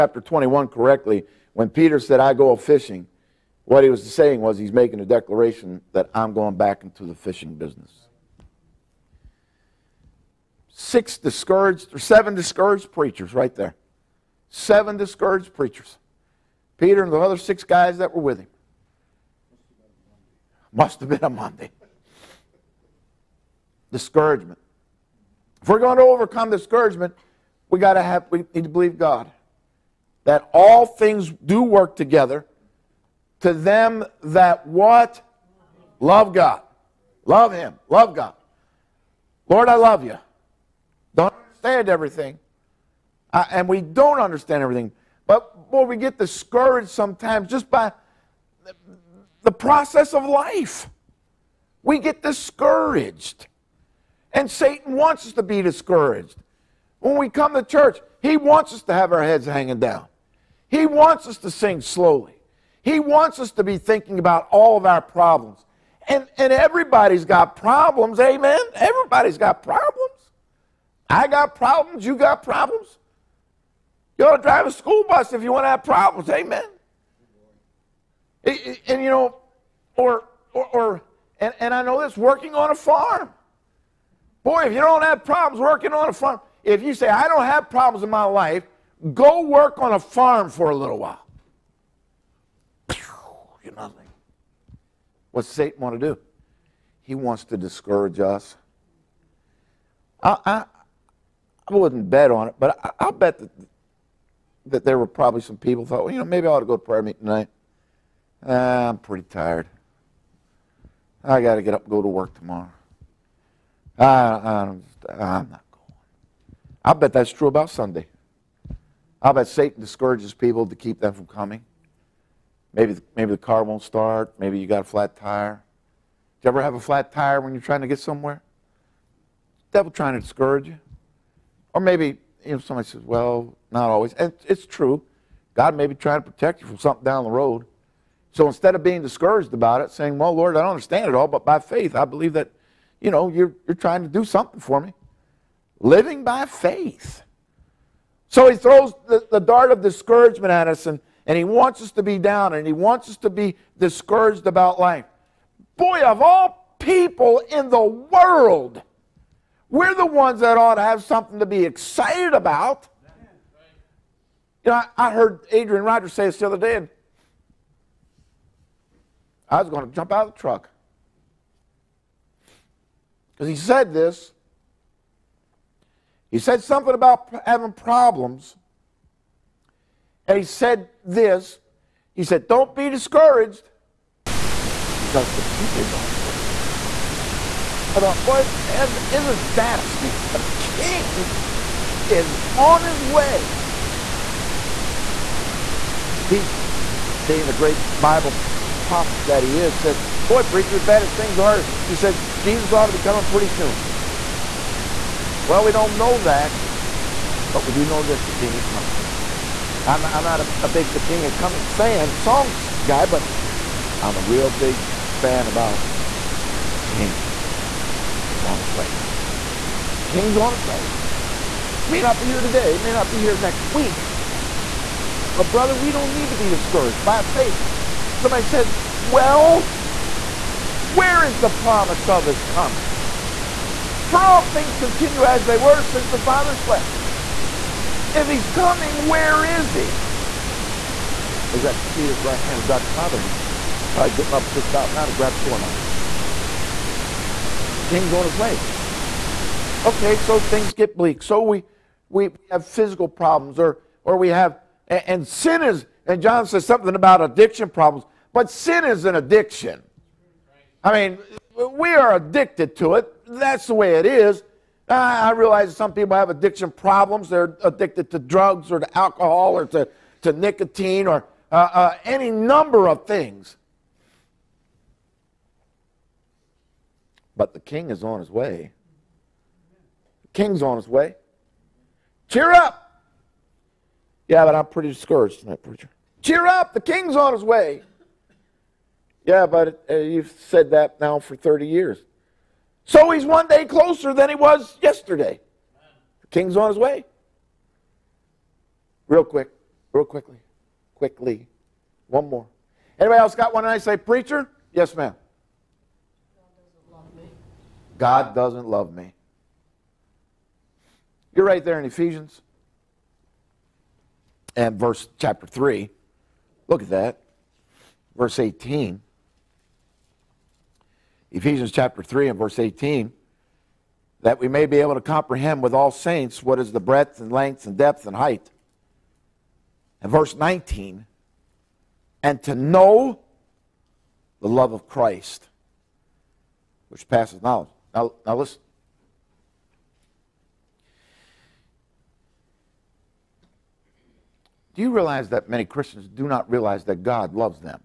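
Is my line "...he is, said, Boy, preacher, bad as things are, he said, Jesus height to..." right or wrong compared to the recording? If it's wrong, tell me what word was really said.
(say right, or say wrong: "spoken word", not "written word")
wrong: "ought", not "height".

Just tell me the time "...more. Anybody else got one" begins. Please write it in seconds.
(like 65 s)
302 s.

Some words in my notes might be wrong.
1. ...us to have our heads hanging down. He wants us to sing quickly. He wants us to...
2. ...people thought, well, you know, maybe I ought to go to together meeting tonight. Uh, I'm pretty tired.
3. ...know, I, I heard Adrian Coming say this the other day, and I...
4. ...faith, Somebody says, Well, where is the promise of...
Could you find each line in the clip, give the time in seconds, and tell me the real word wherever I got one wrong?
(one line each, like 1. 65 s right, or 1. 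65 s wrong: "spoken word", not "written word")
1. 58 s wrong: "slowly", not "quickly"
2. 105 s wrong: "prayer", not "together"
3. 164 s wrong: "Rogers", not "Coming"
4. 227 s right.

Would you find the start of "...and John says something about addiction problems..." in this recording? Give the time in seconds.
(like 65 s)
256 s.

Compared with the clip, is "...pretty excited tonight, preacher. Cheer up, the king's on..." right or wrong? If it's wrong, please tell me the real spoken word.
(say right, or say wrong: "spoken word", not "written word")
wrong: "discouraged", not "excited".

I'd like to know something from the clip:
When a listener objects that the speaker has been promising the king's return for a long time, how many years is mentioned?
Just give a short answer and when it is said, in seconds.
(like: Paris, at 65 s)
30, at 291 s.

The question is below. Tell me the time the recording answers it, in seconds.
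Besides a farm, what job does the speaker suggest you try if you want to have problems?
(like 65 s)
74 s.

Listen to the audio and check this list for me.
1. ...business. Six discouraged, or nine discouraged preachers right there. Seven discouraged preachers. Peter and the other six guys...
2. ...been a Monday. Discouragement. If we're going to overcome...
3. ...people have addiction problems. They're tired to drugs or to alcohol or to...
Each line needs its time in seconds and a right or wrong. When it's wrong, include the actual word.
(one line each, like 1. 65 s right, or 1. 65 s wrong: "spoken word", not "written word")
1. 7 s wrong: "seven", not "nine"
2. 21 s right
3. 265 s wrong: "addicted", not "tired".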